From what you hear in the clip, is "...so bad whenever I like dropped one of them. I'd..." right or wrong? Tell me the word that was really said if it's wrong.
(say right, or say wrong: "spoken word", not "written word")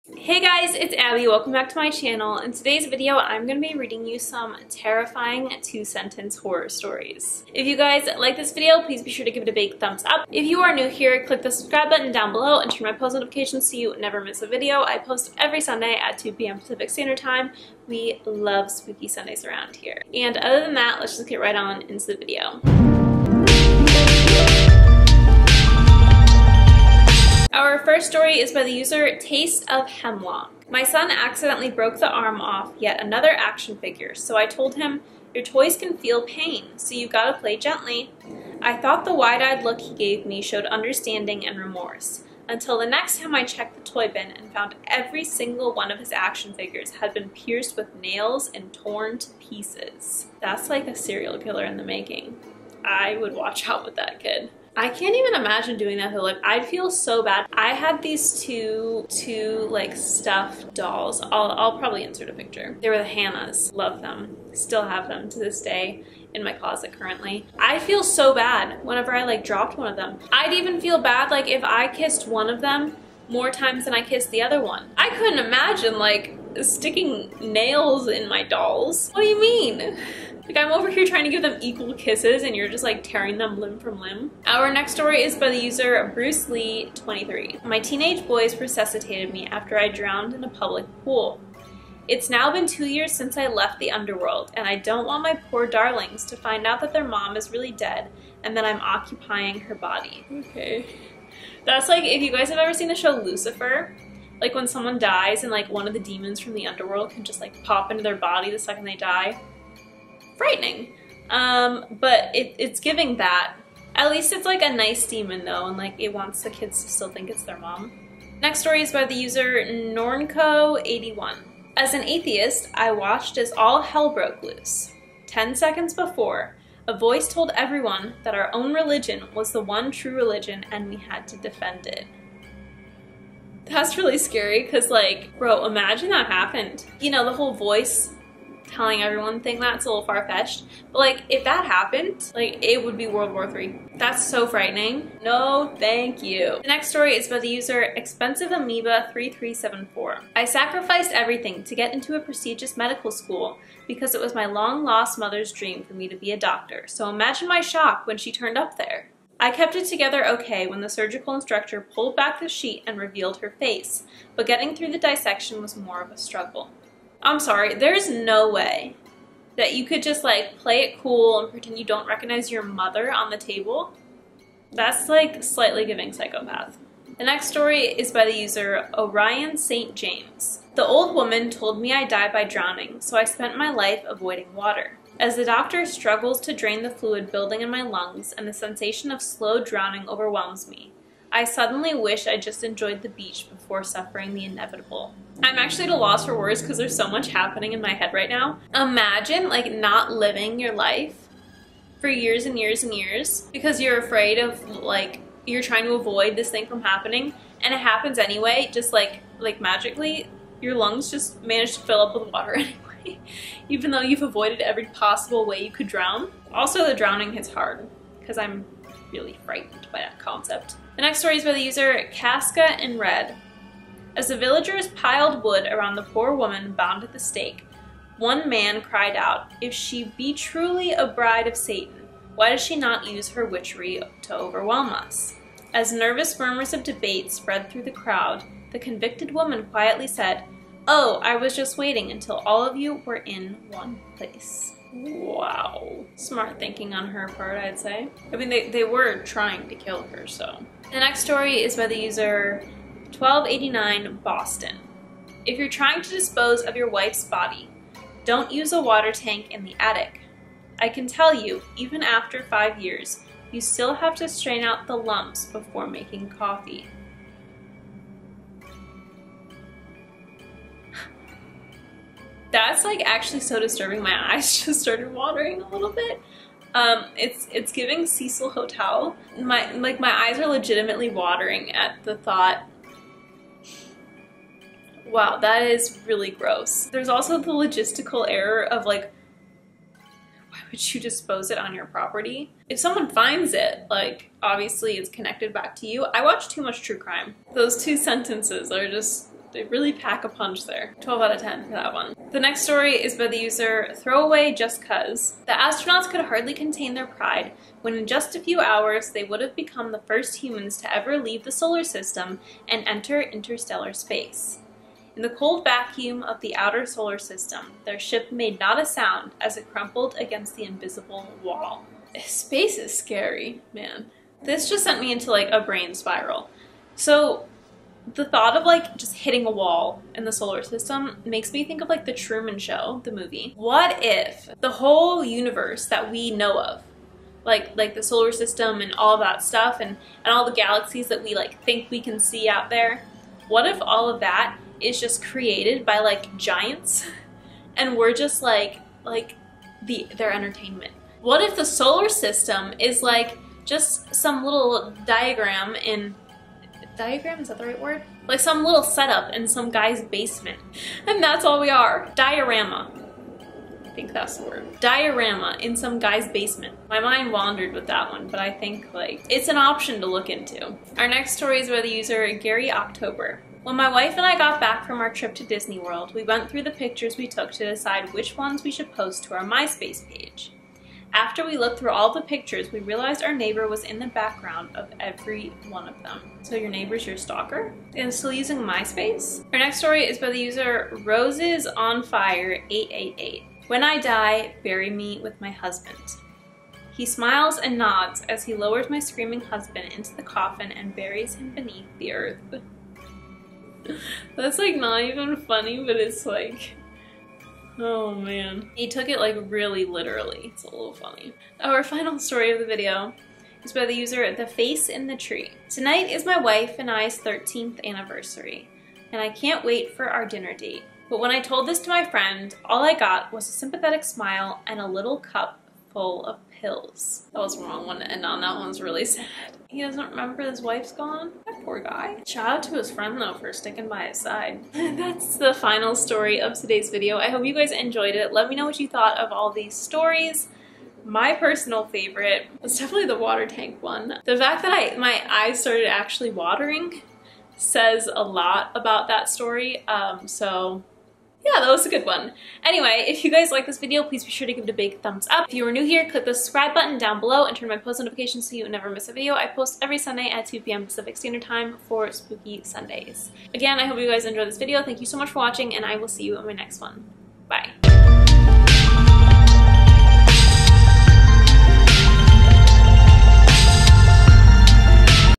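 right.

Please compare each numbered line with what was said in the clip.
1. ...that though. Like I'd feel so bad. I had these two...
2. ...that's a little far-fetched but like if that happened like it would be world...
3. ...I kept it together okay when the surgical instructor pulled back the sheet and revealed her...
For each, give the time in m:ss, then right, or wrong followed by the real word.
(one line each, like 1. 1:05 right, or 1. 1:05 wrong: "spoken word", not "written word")
1. 0:55 right
2. 2:19 right
3. 2:39 right.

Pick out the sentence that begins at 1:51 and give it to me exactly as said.
Um, but it, it's giving that.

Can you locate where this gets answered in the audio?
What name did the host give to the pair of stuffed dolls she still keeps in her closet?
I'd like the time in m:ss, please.
1:02.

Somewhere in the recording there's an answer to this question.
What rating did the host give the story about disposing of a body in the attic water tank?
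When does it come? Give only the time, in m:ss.
5:01.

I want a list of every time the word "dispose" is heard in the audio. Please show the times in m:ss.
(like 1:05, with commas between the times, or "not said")
4:16, 4:51.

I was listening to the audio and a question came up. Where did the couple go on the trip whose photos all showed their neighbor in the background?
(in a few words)
Disney World.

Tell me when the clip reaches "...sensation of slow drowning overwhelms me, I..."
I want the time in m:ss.
3:08.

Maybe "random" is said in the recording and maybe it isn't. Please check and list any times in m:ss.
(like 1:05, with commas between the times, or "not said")
not said.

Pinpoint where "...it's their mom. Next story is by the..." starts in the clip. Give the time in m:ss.
1:57.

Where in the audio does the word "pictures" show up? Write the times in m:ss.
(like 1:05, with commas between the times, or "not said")
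1:02, 6:16, 6:22.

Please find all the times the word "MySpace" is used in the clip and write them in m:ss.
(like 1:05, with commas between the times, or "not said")
6:19, 6:28.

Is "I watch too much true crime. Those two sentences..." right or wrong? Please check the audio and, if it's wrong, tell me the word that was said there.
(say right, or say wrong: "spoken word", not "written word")
right.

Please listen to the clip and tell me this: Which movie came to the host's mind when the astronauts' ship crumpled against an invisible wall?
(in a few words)
The Truman Show.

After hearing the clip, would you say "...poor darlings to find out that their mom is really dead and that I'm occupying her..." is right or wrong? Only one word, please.
right.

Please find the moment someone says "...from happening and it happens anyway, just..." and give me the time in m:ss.
3:26.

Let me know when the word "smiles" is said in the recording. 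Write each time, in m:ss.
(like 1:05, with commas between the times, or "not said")
6:37, 7:04.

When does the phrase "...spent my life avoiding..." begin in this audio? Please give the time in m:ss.
3:03.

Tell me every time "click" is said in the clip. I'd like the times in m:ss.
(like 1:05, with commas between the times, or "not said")
0:11, 7:36.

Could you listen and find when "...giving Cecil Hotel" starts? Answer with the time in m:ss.
4:37.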